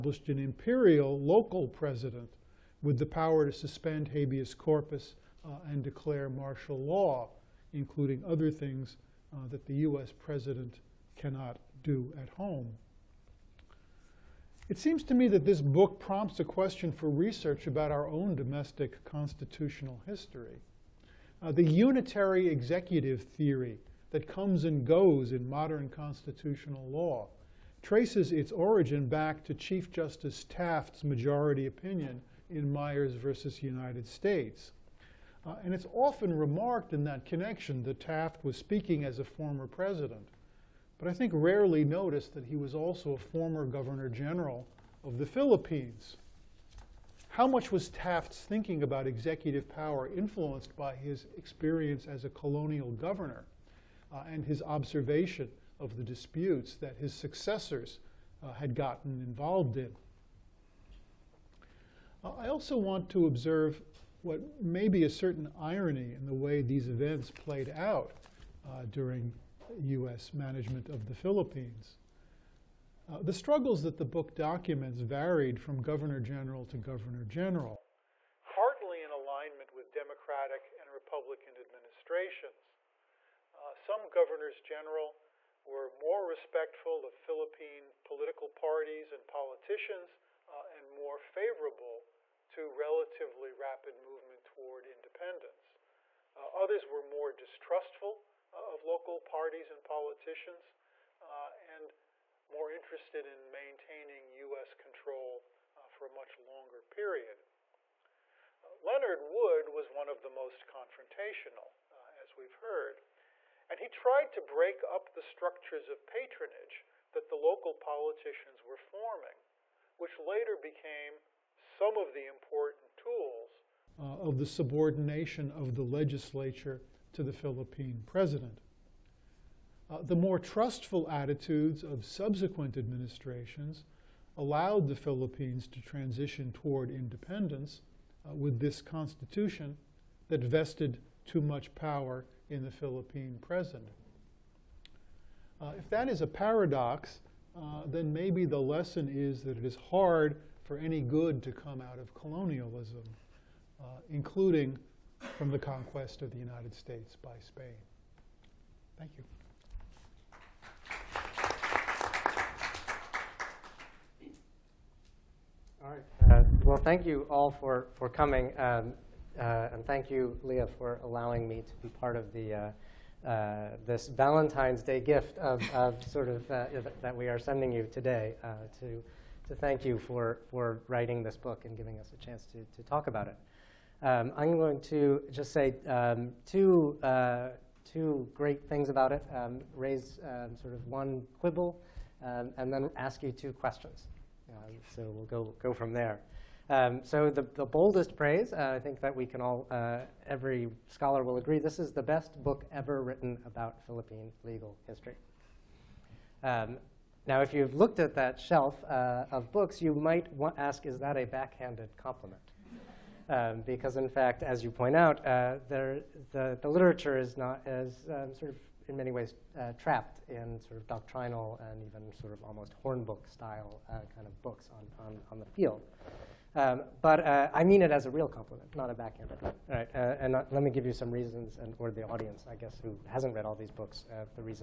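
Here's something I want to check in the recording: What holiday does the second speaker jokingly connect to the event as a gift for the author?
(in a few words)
Valentine's Day.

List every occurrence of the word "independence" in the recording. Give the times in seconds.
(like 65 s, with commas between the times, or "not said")
94 s, 136 s.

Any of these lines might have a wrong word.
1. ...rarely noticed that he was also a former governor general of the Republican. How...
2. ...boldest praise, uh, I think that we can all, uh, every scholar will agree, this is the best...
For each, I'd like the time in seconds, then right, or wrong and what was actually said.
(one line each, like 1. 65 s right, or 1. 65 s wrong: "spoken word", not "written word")
1. 41 s wrong: "Philippines", not "Republican"
2. 197 s right.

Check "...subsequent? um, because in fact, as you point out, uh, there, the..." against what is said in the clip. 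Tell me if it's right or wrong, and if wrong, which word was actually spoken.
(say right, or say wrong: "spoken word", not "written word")
wrong: "compliment", not "subsequent".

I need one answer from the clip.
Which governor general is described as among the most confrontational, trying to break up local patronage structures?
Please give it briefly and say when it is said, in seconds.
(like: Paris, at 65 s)
Leonard Wood, at 108 s.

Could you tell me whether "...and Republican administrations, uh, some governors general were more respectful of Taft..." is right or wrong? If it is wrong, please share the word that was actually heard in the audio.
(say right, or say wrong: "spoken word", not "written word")
wrong: "Philippine", not "Taft".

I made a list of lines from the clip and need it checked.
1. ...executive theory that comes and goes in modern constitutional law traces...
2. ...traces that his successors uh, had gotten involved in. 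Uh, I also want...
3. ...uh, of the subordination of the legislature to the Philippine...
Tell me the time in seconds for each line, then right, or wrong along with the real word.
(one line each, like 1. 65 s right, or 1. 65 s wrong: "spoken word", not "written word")
1. 22 s right
2. 56 s wrong: "disputes", not "traces"
3. 123 s right.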